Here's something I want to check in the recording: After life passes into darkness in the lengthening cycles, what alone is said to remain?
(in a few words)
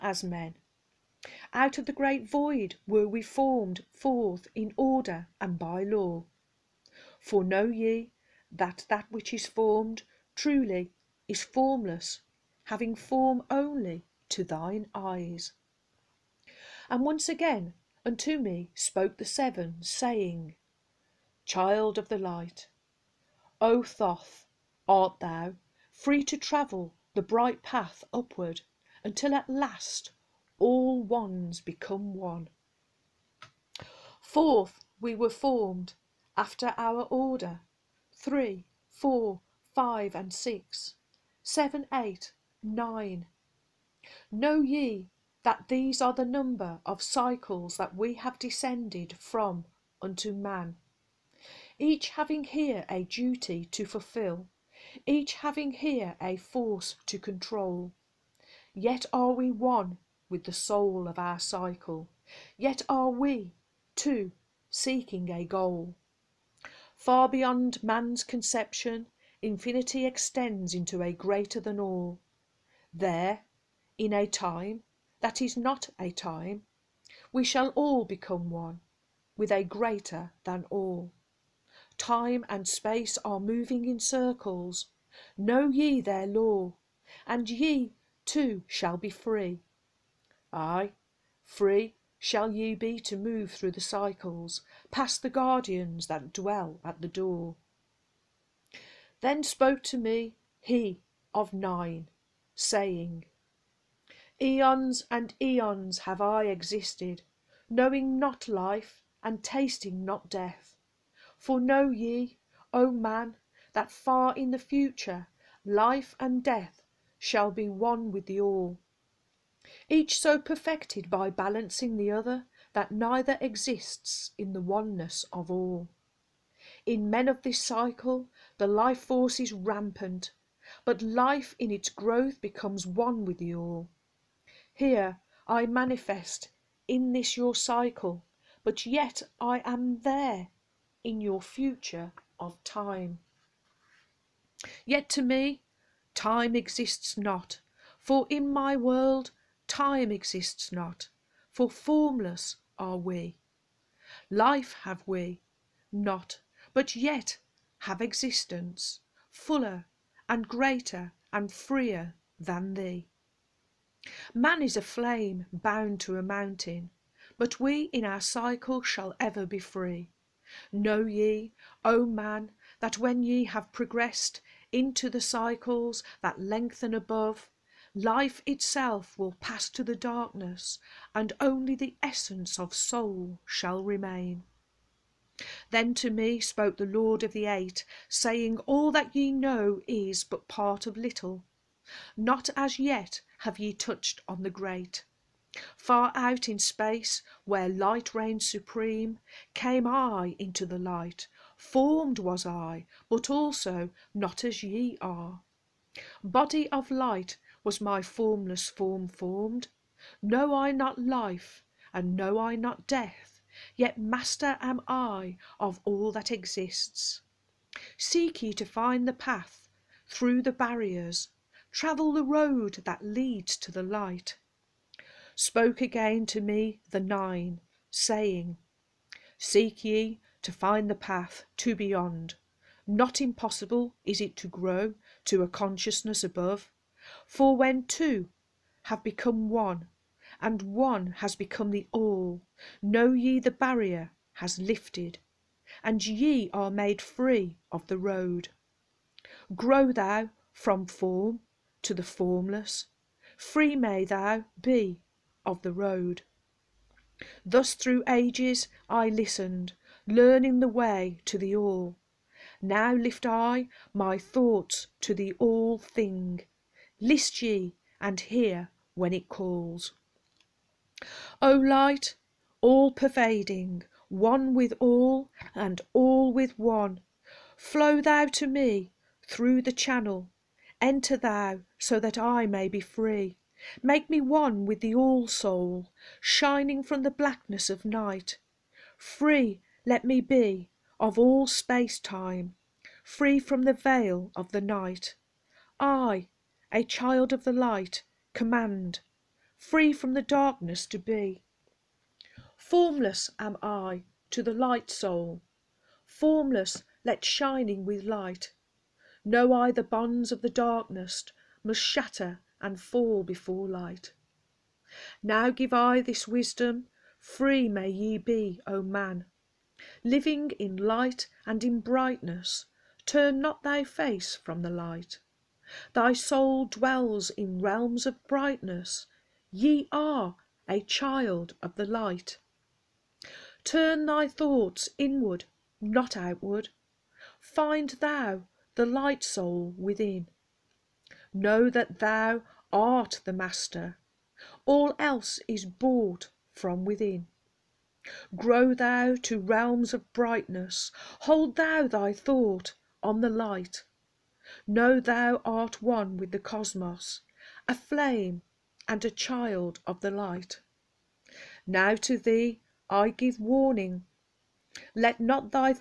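the essence of soul.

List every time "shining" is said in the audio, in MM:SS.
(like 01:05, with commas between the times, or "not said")
04:46, 05:07.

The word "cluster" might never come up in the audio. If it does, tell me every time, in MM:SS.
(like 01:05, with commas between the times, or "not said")
not said.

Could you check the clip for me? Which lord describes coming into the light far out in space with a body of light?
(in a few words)
the Lord of the Eight.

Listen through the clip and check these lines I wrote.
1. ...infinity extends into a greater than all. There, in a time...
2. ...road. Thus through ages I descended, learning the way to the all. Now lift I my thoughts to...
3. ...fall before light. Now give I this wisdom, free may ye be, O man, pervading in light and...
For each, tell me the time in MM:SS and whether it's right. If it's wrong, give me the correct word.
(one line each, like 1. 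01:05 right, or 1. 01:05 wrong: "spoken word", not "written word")
1. 01:09 right
2. 04:15 wrong: "listened", not "descended"
3. 05:12 wrong: "living", not "pervading".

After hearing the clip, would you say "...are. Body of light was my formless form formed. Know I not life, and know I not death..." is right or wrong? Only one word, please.
right.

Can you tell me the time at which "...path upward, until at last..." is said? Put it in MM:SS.
00:27.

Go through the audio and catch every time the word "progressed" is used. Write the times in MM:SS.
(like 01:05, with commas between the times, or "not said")
02:53.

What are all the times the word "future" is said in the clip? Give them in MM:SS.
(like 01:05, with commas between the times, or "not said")
01:54, 02:21.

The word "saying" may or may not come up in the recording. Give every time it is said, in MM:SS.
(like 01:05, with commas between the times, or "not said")
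00:19, 01:42, 03:08, 03:47.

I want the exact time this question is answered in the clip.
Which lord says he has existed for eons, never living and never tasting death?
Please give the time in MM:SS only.
01:40.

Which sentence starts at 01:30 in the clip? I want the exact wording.
Ay, free shall ye be to move through the cycles, past the guardians that dwell at the door.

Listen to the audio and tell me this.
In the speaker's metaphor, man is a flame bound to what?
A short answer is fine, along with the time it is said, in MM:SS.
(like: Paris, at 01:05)
a mountain, at 02:46.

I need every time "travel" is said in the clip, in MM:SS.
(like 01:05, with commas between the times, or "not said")
00:26, 03:41.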